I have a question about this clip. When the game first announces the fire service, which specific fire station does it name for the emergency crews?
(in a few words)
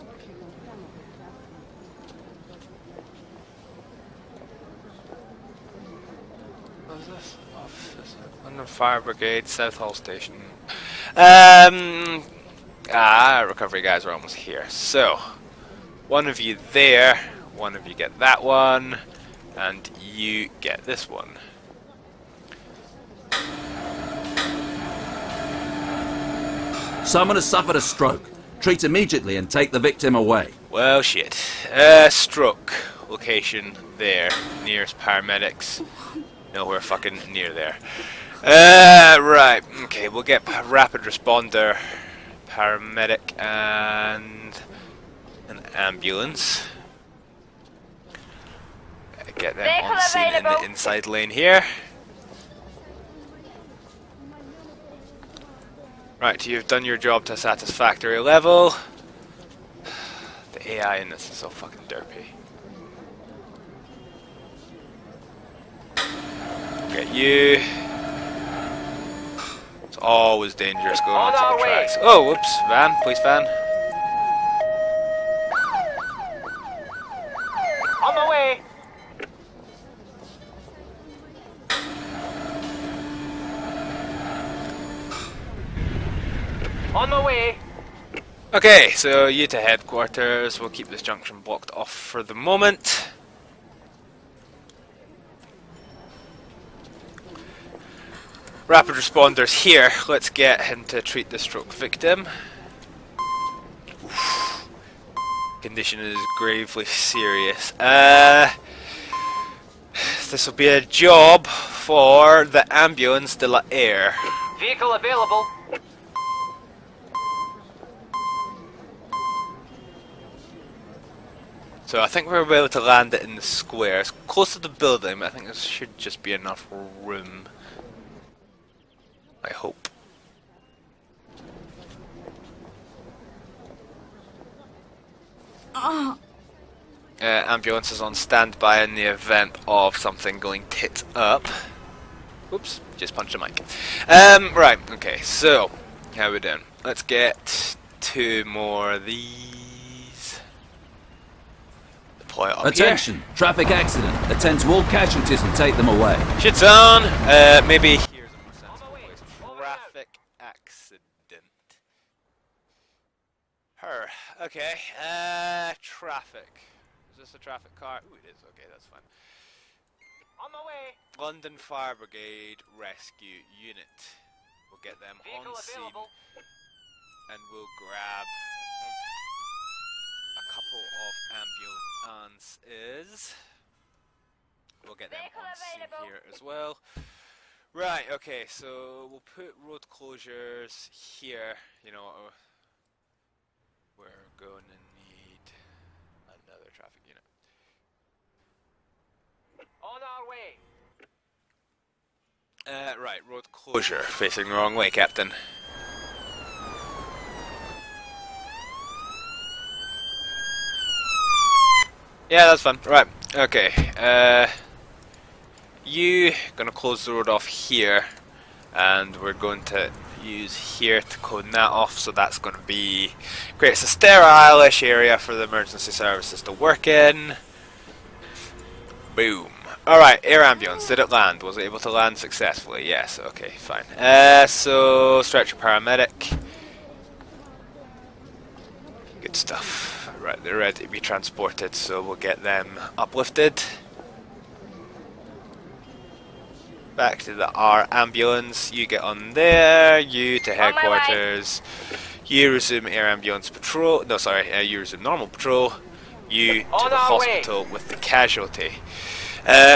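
Southall Station.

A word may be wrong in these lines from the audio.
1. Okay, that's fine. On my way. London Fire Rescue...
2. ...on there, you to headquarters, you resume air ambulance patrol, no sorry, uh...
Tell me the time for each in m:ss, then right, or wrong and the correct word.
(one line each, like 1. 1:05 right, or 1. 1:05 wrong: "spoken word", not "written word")
1. 2:48 wrong: "Brigade", not "Rescue"
2. 4:08 right.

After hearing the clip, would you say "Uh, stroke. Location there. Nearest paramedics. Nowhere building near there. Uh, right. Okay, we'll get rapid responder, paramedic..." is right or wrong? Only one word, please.
wrong.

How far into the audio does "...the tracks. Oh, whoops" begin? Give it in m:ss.
1:11.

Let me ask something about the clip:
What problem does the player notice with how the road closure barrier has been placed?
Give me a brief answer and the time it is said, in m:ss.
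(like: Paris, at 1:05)
Facing the wrong way, at 3:23.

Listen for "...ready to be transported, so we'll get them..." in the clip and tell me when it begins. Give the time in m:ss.
4:00.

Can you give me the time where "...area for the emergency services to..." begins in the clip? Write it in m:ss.
3:44.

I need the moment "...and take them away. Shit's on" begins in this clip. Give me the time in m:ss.
2:35.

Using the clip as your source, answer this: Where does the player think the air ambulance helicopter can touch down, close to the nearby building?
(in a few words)
The square.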